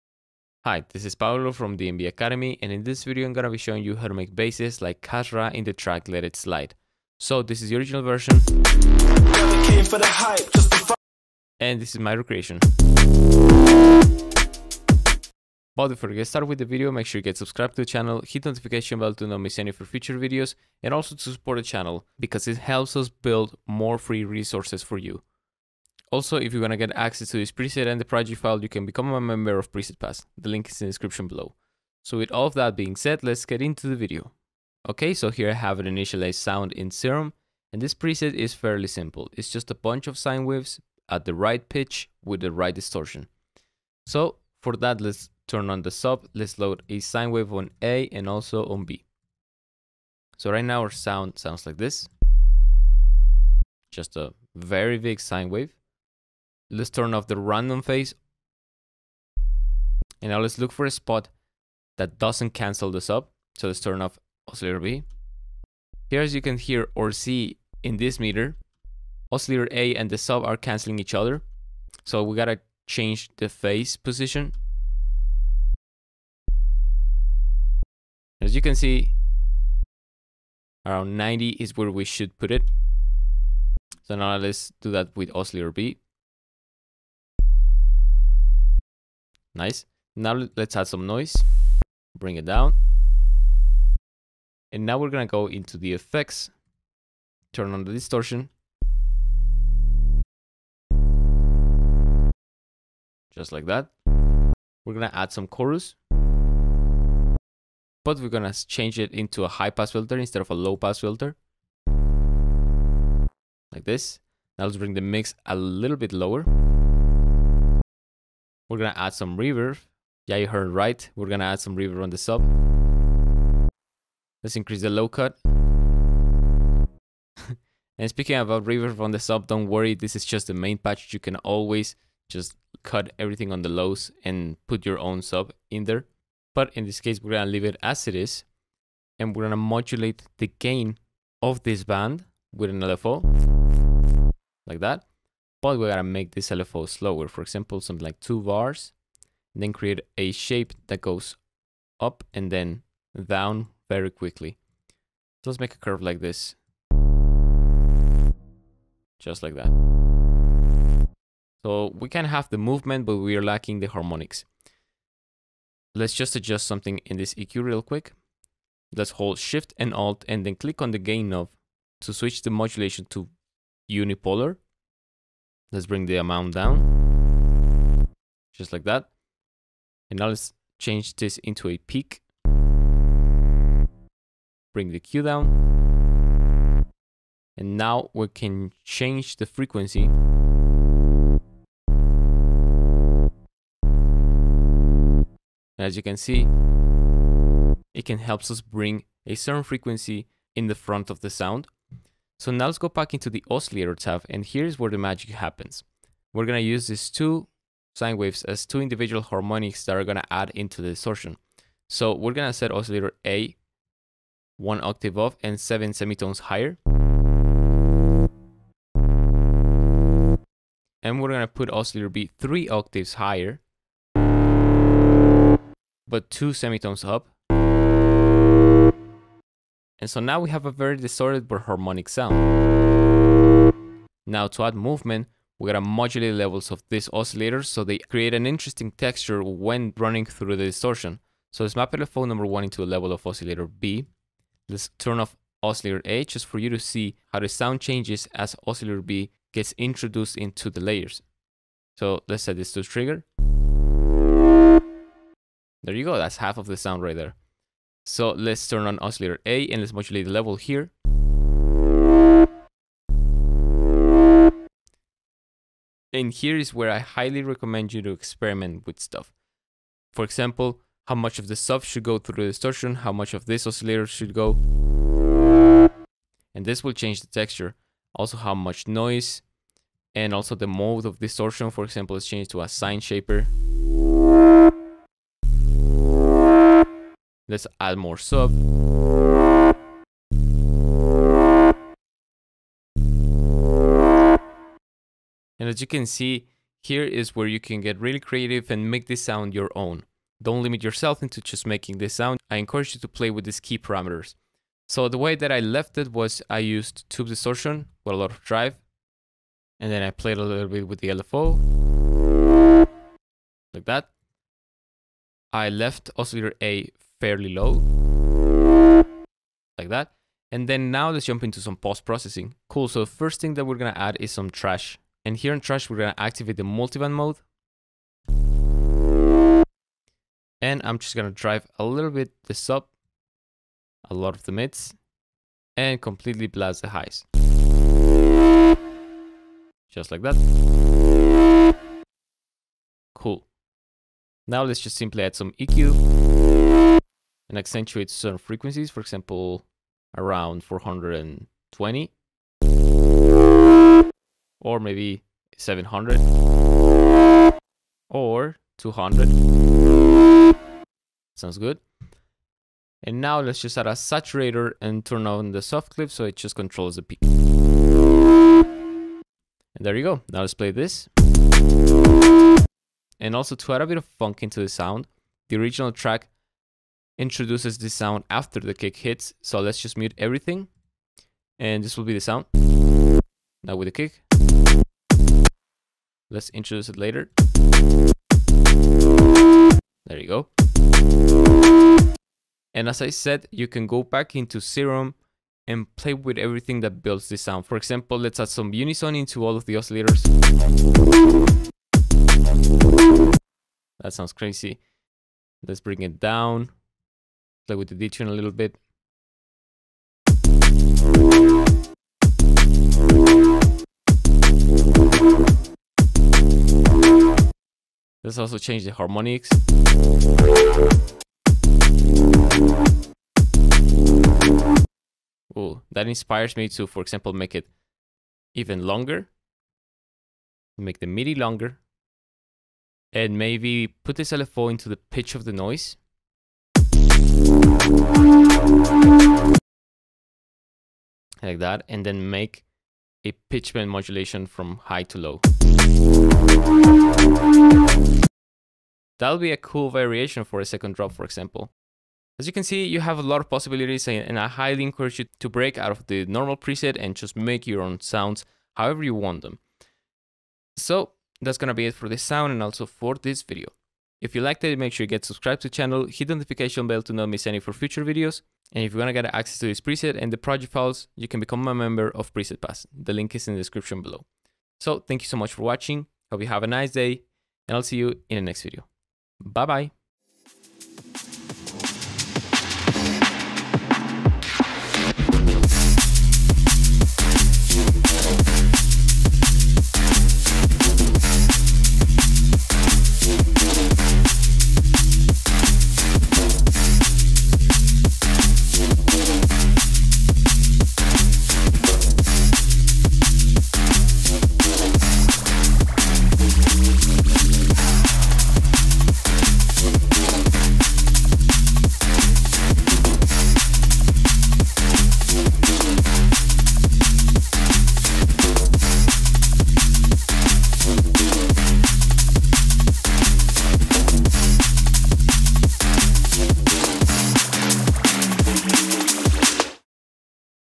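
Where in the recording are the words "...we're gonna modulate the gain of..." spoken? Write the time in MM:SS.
02:19.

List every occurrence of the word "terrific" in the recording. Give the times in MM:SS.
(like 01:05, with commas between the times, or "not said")
not said.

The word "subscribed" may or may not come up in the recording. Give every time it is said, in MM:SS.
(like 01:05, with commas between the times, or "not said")
00:17, 07:45.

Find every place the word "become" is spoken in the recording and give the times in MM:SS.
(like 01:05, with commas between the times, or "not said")
00:28, 07:51.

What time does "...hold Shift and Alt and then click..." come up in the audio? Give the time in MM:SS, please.
02:49.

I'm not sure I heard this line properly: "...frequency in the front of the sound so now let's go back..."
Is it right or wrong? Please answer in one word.
right.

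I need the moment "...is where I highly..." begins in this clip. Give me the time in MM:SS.
04:26.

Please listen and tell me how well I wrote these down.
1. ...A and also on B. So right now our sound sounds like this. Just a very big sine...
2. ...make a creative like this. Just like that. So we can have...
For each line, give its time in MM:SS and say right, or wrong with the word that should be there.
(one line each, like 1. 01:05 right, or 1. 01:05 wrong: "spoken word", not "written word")
1. 00:47 right
2. 02:35 wrong: "curve", not "creative".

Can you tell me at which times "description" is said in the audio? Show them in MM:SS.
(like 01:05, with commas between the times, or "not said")
00:30, 07:53.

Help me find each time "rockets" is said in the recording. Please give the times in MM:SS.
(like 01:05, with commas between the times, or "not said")
not said.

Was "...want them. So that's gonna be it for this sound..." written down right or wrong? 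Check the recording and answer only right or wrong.
right.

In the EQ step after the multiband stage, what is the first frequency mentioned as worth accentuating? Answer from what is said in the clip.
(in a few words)
420.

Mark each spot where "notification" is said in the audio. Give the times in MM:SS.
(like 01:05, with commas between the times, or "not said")
00:18, 07:46.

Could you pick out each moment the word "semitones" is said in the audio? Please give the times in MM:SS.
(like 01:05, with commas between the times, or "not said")
03:35, 03:46.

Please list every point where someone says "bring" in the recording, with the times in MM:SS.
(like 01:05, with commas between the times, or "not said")
01:32, 01:54, 02:55, 03:04, 03:18, 06:45.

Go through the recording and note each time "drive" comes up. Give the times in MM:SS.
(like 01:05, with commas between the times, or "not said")
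05:08, 05:31.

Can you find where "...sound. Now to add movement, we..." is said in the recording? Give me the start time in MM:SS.
03:52.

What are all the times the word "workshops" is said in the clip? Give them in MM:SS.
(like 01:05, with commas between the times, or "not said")
not said.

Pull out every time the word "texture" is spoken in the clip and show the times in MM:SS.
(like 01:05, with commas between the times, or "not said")
03:58, 04:37.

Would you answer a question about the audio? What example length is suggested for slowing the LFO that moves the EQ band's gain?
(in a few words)
two bars.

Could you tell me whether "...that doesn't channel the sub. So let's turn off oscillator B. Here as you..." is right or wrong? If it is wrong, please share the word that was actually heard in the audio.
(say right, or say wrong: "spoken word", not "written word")
wrong: "cancel", not "channel".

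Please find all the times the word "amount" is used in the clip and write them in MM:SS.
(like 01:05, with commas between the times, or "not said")
02:56.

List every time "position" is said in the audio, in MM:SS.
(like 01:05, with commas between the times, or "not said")
01:13.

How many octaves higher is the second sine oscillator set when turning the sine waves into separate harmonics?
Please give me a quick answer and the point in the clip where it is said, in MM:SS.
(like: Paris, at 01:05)
3, at 03:42.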